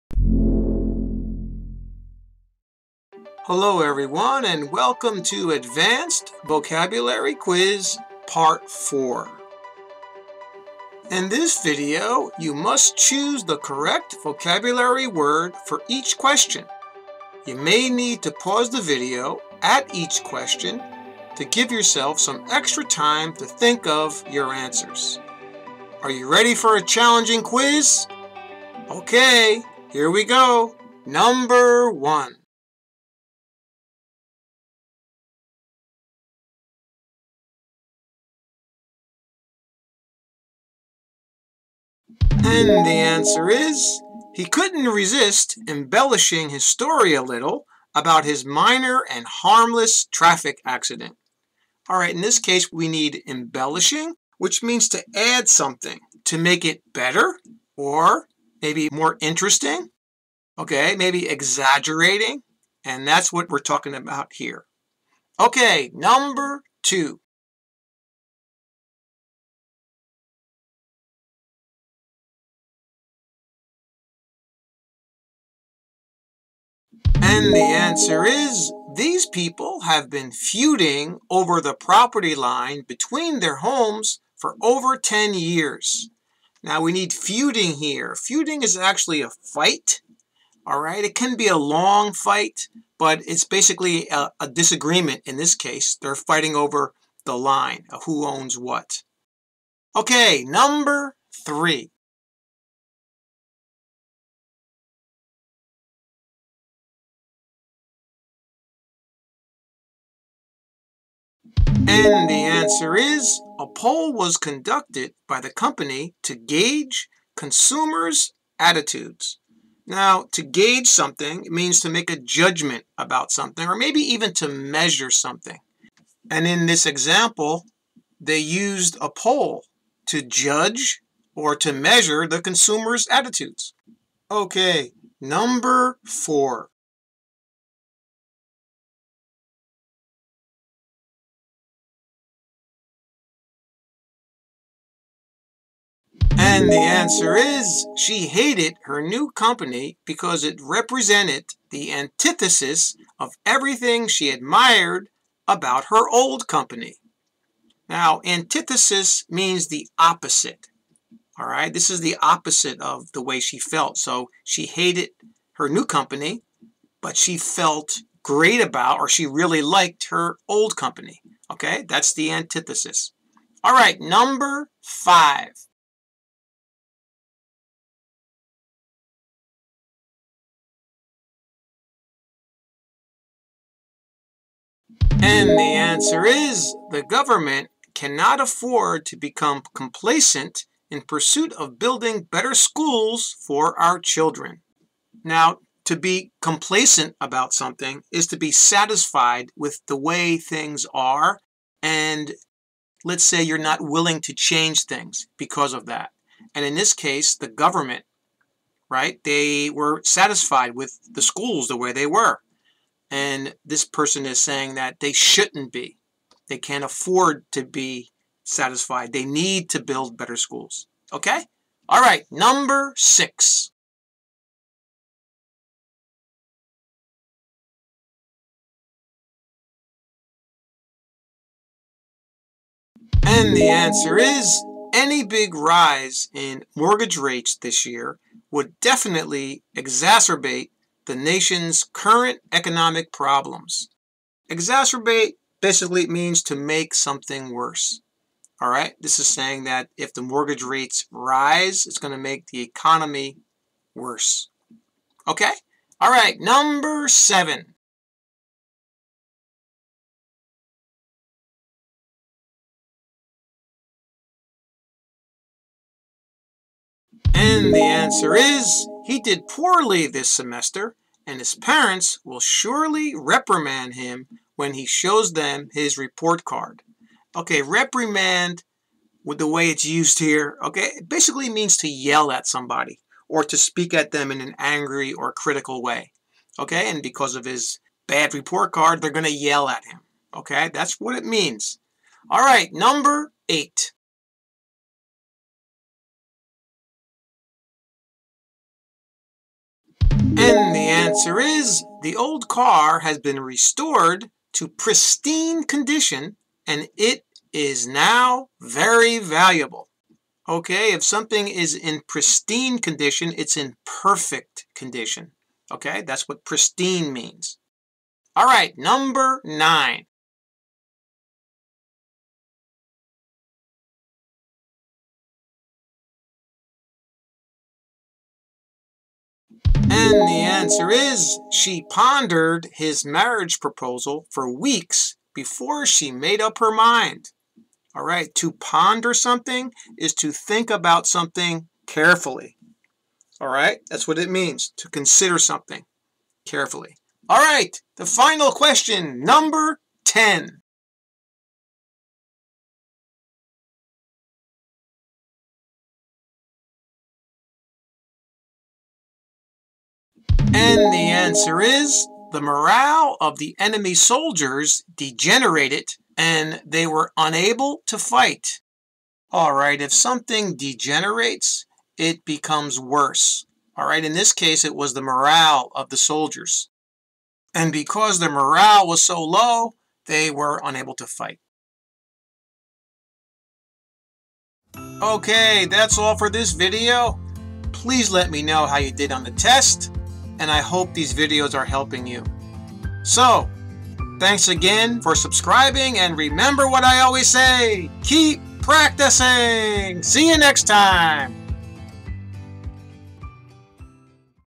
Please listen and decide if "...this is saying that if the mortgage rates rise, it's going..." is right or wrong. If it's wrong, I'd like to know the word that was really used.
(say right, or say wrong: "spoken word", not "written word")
right.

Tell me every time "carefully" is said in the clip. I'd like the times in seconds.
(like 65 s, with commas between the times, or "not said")
341 s, 346 s.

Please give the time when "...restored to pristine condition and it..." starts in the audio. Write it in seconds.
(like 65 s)
303 s.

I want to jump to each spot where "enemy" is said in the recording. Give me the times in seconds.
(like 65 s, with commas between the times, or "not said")
363 s.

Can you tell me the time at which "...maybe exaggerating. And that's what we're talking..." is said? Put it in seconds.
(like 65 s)
60 s.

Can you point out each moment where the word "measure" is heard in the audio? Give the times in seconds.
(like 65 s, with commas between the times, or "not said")
124 s, 131 s.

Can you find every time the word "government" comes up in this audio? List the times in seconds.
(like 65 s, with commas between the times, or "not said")
187 s, 207 s.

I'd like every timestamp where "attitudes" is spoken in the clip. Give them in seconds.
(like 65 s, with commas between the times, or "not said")
118 s, 133 s.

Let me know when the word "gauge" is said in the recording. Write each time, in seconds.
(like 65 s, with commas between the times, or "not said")
116 s, 120 s.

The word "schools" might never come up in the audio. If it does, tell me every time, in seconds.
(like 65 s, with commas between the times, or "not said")
192 s, 211 s, 220 s.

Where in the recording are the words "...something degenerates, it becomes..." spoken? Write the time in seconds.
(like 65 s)
369 s.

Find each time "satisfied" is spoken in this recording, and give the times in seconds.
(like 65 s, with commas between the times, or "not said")
198 s, 210 s, 218 s.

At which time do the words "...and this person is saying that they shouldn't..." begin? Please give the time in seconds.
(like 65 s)
213 s.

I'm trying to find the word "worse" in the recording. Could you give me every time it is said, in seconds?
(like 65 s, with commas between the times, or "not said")
247 s, 253 s, 372 s.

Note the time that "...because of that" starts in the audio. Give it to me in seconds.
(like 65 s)
205 s.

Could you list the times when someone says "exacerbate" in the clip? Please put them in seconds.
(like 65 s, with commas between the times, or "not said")
239 s, 244 s.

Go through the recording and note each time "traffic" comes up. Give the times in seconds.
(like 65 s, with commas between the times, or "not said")
50 s.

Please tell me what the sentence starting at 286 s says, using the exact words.
Okay, and because of his bad report card, they're going to yell at him.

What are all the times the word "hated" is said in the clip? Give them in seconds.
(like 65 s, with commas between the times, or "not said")
148 s, 164 s.